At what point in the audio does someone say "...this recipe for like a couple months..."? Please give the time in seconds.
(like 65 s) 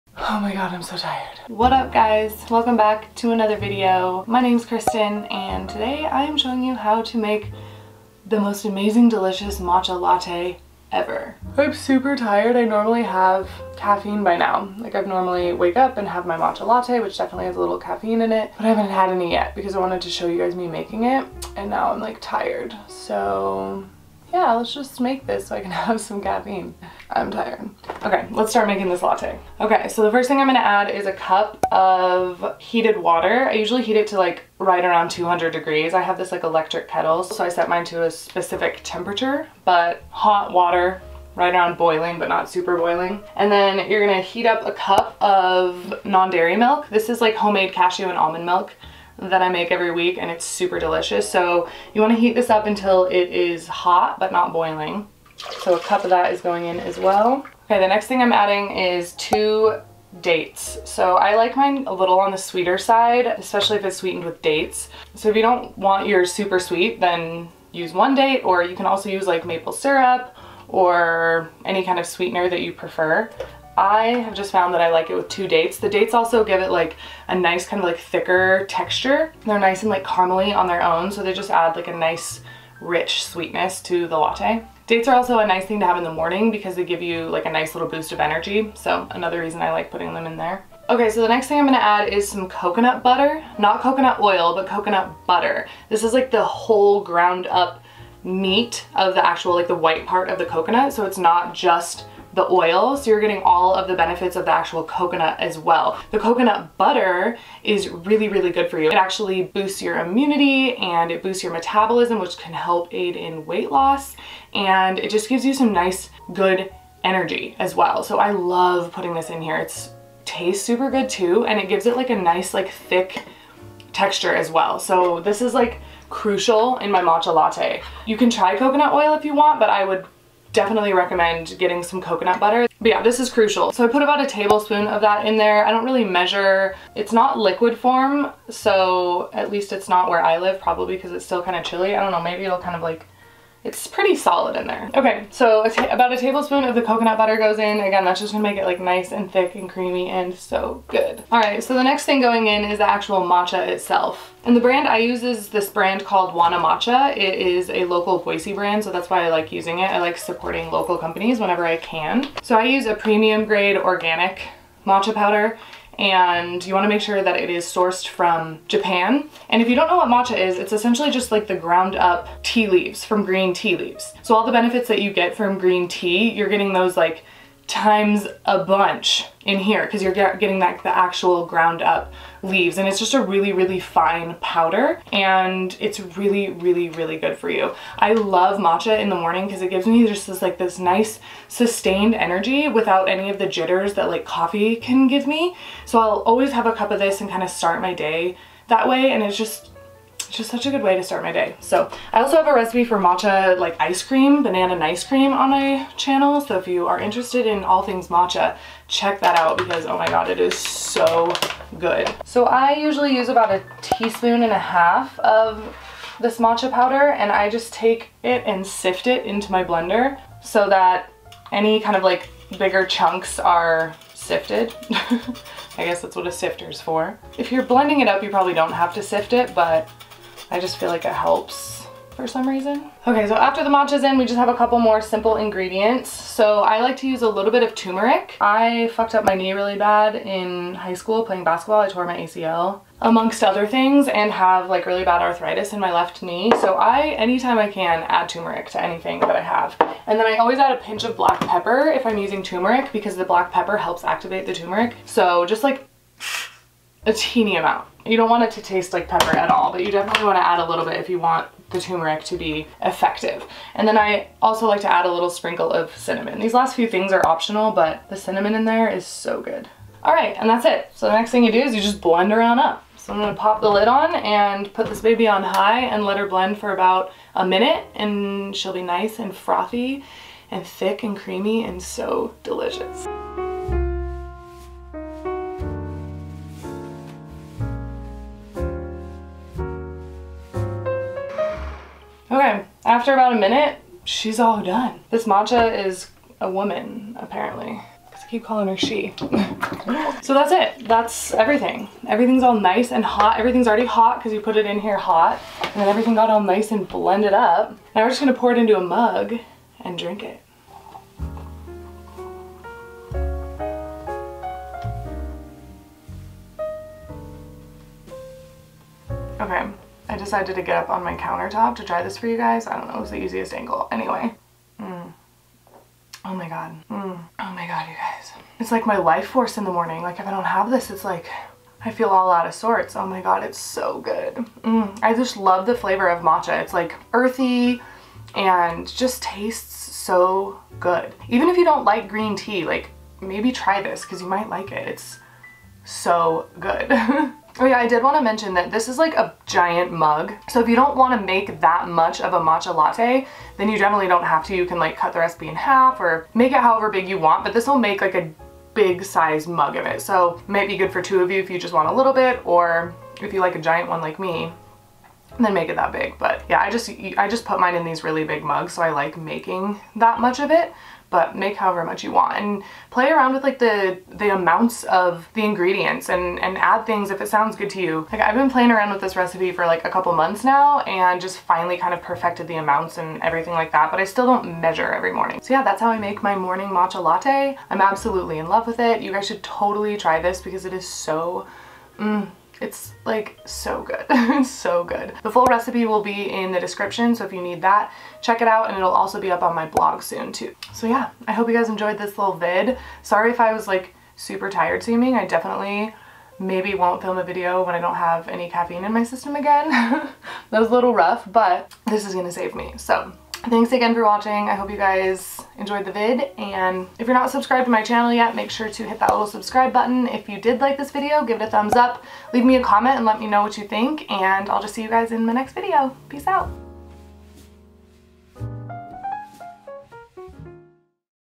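379 s.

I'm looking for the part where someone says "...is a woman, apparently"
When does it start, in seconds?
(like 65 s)
295 s.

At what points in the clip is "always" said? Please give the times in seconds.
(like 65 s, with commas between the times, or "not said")
196 s, 250 s.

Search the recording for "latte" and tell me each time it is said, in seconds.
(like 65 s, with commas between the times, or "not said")
9 s, 16 s, 29 s, 84 s, 127 s, 352 s, 387 s.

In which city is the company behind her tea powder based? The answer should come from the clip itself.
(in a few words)
Boise.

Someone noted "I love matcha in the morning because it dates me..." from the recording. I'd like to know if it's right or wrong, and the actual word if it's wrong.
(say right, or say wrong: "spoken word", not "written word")
wrong: "gives", not "dates".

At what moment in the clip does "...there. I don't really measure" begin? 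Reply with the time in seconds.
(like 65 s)
135 s.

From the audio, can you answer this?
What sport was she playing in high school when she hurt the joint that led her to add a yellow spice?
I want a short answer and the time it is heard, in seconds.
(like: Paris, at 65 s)
Basketball, at 241 s.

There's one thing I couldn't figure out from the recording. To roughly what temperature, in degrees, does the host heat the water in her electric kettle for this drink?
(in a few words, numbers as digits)
200.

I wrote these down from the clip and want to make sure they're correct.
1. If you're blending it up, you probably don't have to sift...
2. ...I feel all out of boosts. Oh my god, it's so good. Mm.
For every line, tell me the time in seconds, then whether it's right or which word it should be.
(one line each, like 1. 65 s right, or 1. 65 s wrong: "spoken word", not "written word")
1. 227 s right
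2. 331 s wrong: "sorts", not "boosts".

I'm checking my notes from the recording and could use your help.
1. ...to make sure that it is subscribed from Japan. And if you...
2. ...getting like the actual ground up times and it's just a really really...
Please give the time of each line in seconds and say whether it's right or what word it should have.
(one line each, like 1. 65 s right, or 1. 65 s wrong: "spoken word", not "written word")
1. 166 s wrong: "sourced", not "subscribed"
2. 180 s wrong: "leaves", not "times".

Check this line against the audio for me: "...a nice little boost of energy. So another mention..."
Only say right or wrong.
wrong.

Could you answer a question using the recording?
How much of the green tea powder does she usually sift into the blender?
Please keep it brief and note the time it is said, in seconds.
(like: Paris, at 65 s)
1.5 teaspoons, at 213 s.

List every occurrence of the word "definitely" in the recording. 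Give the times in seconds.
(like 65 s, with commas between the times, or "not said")
17 s, 130 s, 259 s, 353 s, 405 s.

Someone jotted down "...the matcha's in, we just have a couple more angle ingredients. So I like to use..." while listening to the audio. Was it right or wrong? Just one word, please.
wrong.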